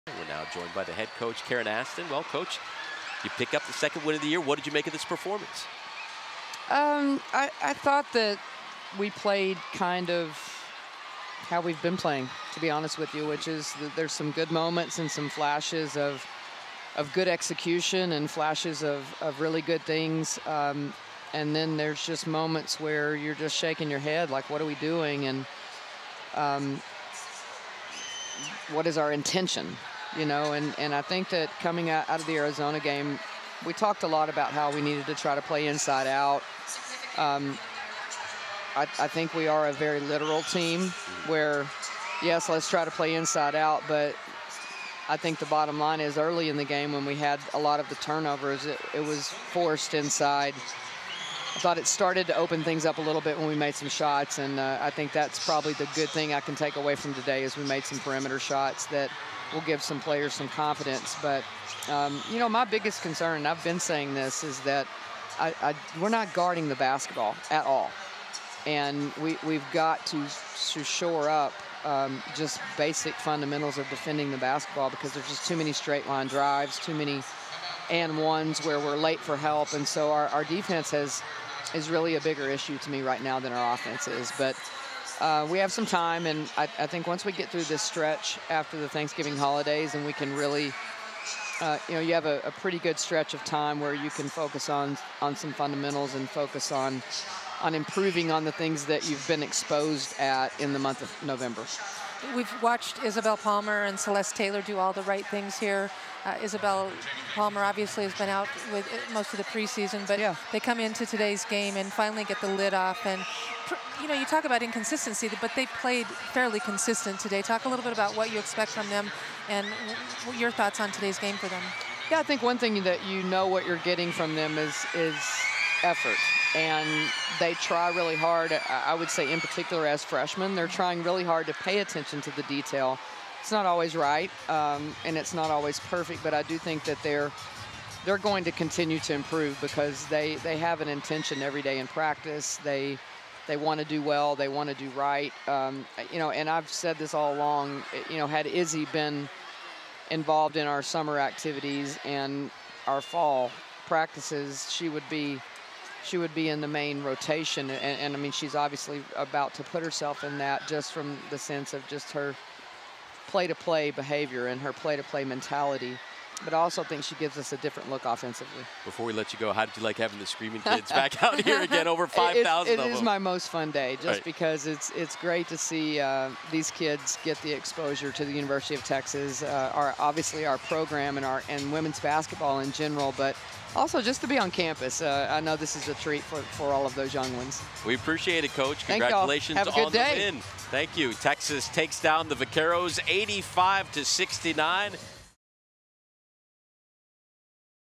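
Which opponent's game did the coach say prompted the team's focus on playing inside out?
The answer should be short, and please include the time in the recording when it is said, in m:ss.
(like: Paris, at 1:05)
Arizona, at 0:32.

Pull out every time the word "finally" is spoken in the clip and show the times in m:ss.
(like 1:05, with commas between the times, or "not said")
1:51.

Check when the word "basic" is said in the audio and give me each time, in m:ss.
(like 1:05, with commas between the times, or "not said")
1:12.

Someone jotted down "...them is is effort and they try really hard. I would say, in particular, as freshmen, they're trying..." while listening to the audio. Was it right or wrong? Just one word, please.
right.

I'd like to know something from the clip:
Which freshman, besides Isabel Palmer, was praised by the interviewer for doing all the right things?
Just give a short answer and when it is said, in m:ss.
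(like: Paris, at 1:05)
Celeste Taylor, at 1:43.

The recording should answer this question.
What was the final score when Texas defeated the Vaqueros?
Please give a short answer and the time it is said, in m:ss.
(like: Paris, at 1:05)
85 to 69, at 3:13.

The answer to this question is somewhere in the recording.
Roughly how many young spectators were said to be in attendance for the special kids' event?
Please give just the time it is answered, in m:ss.
2:52.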